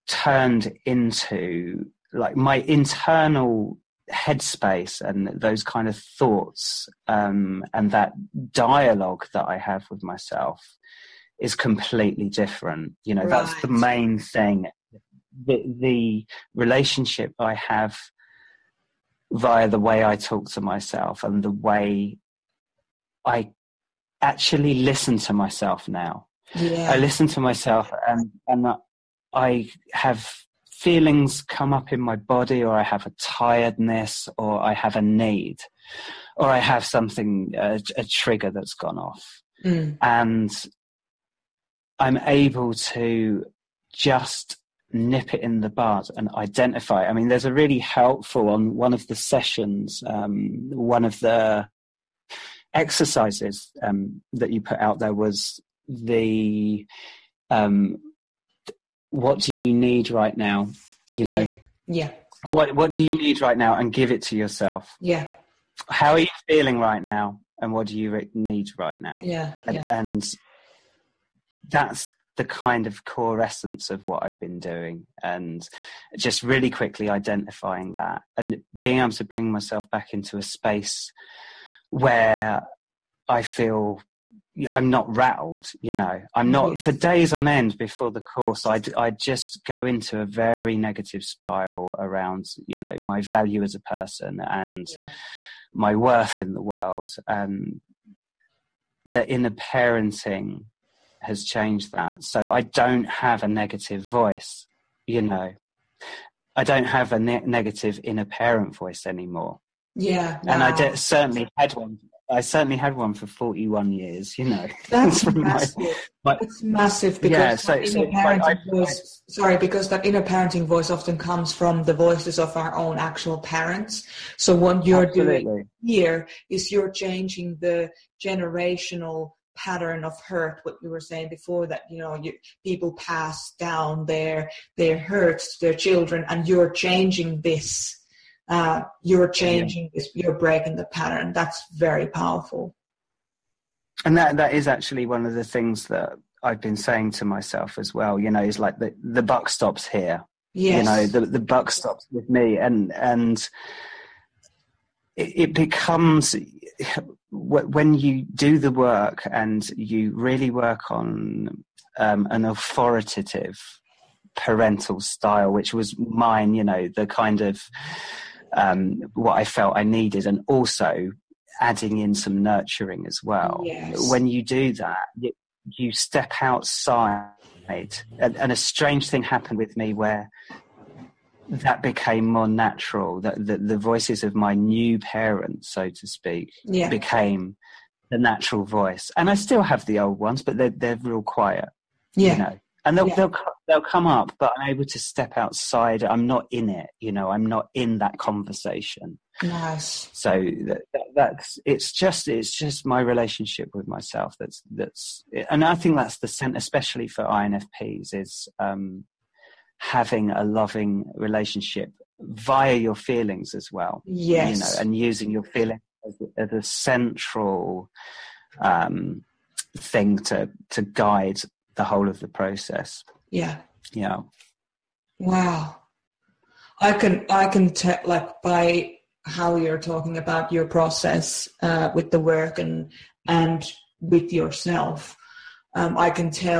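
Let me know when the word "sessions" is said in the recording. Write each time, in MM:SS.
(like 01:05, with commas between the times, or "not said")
00:49.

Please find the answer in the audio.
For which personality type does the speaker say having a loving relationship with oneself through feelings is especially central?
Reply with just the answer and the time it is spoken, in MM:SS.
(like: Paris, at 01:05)
INFPs, at 03:27.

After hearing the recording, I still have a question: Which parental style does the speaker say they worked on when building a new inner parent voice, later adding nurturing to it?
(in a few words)
Authoritative.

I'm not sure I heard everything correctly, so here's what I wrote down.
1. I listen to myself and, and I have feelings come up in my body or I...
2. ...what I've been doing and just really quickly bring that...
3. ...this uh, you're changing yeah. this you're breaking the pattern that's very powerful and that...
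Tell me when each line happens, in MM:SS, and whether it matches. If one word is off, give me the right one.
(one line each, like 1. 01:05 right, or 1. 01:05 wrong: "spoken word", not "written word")
1. 00:26 right
2. 01:14 wrong: "identifying", not "bring"
3. 02:17 right.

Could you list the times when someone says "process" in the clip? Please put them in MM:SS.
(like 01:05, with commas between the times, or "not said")
03:42, 03:50.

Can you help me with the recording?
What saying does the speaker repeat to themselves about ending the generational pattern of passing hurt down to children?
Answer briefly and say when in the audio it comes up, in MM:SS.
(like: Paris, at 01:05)
The buck stops here, at 02:29.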